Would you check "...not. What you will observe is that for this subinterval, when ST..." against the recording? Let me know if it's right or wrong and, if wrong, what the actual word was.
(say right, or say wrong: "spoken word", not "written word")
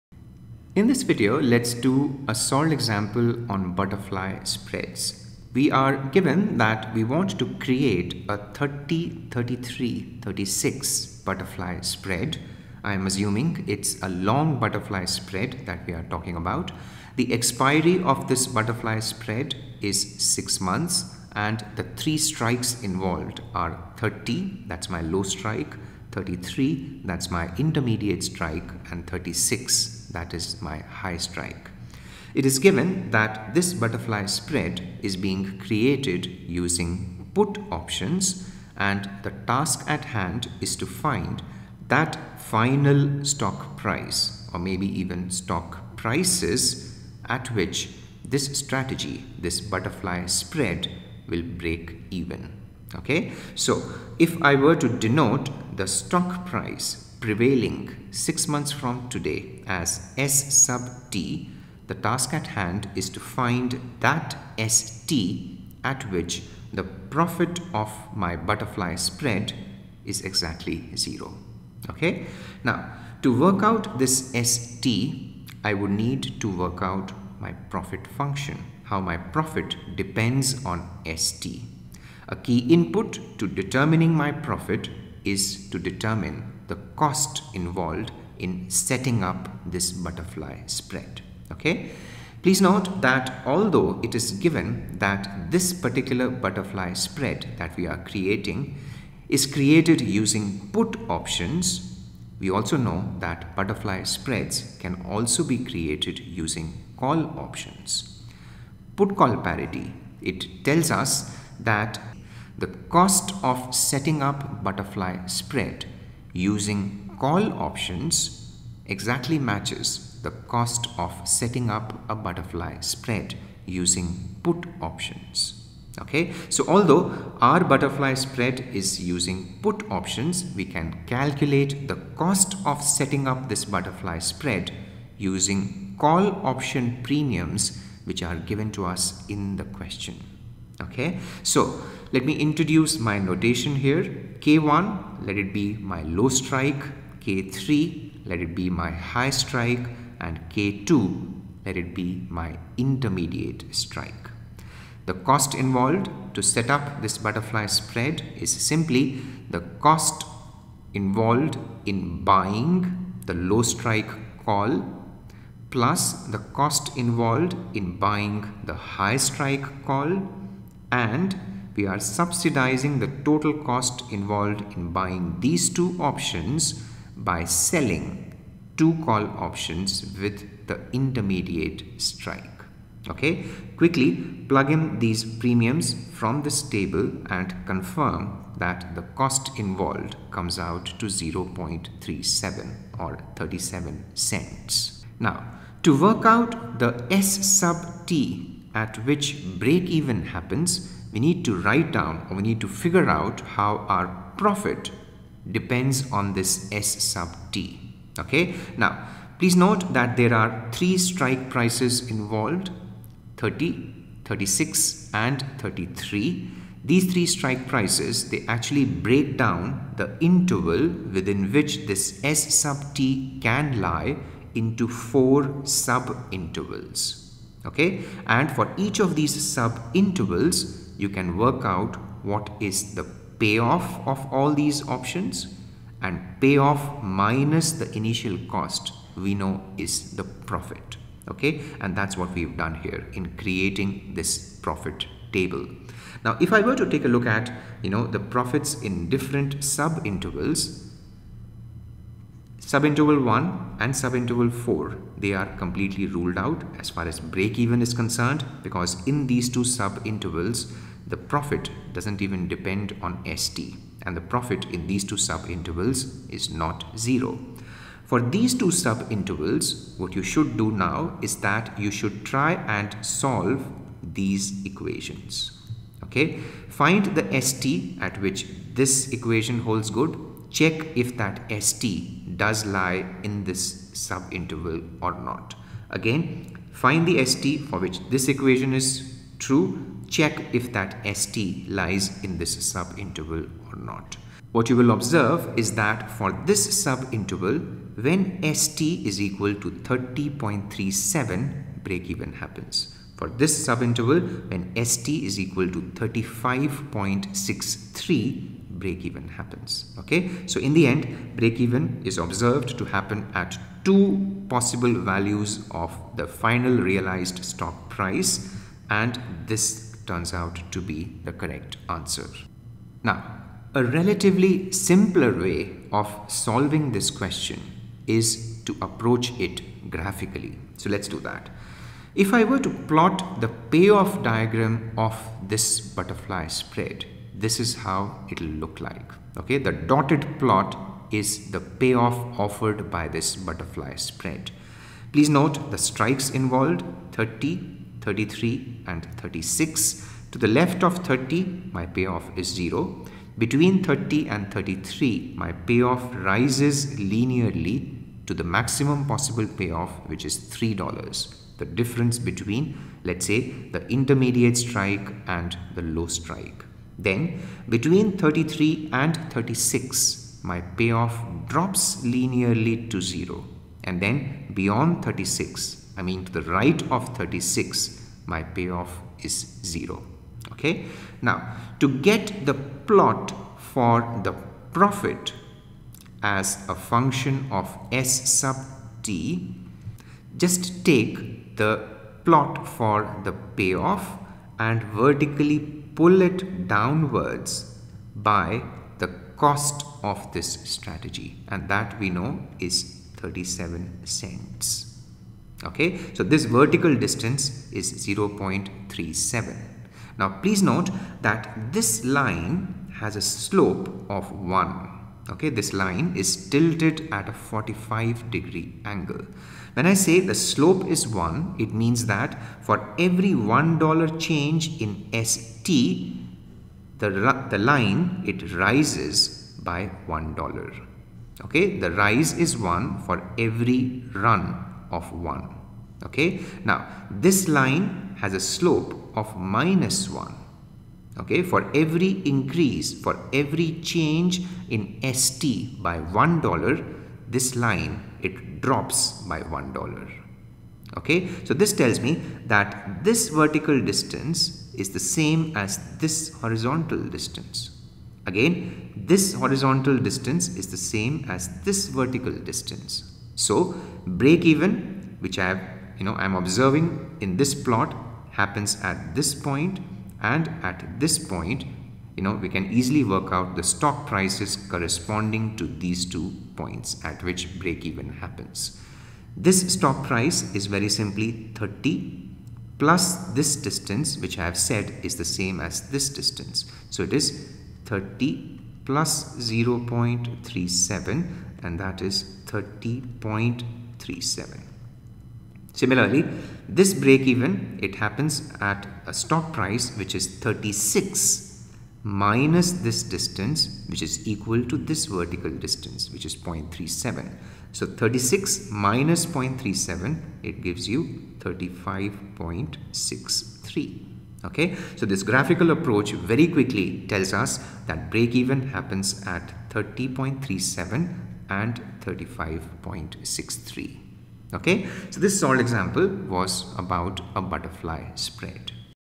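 right.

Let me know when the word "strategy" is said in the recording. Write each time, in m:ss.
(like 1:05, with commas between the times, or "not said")
0:48, 6:40.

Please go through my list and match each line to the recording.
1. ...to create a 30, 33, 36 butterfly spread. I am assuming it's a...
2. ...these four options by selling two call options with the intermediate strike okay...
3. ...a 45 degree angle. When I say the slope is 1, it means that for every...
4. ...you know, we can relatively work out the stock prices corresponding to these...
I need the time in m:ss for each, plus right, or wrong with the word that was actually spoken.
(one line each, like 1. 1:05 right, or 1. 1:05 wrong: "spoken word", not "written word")
1. 0:07 right
2. 2:55 wrong: "two", not "four"
3. 6:57 right
4. 7:52 wrong: "easily", not "relatively".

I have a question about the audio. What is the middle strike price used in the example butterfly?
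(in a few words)
33.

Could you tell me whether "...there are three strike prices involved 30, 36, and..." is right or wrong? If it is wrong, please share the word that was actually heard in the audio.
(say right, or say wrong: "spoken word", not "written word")
right.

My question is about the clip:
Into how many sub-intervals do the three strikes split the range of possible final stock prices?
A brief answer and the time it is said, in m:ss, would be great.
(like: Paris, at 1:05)
Four, at 3:44.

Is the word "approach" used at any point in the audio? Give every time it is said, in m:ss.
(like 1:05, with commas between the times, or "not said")
5:28, 8:35.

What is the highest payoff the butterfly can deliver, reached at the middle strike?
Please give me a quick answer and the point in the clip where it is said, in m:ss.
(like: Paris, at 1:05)
$3, at 6:00.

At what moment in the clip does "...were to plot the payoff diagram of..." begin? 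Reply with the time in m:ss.
5:32.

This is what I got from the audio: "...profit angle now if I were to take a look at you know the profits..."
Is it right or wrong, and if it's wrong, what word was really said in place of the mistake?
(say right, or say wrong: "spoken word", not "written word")
wrong: "table", not "angle".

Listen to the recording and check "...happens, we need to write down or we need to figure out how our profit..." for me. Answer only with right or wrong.
right.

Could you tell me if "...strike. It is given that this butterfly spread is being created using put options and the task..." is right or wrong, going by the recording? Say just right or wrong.
right.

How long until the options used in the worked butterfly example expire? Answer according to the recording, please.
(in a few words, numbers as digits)
6 months.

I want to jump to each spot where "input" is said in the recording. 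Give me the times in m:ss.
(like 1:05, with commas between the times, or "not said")
1:22.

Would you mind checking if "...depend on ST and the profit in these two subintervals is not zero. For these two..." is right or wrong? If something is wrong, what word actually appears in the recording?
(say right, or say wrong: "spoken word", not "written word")
right.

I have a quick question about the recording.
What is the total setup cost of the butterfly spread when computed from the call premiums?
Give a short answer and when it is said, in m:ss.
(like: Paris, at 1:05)
37 cents, at 3:11.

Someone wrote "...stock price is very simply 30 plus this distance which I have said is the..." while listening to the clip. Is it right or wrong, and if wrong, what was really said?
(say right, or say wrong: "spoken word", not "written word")
right.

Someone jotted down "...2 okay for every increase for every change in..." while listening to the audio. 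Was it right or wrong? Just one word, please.
wrong.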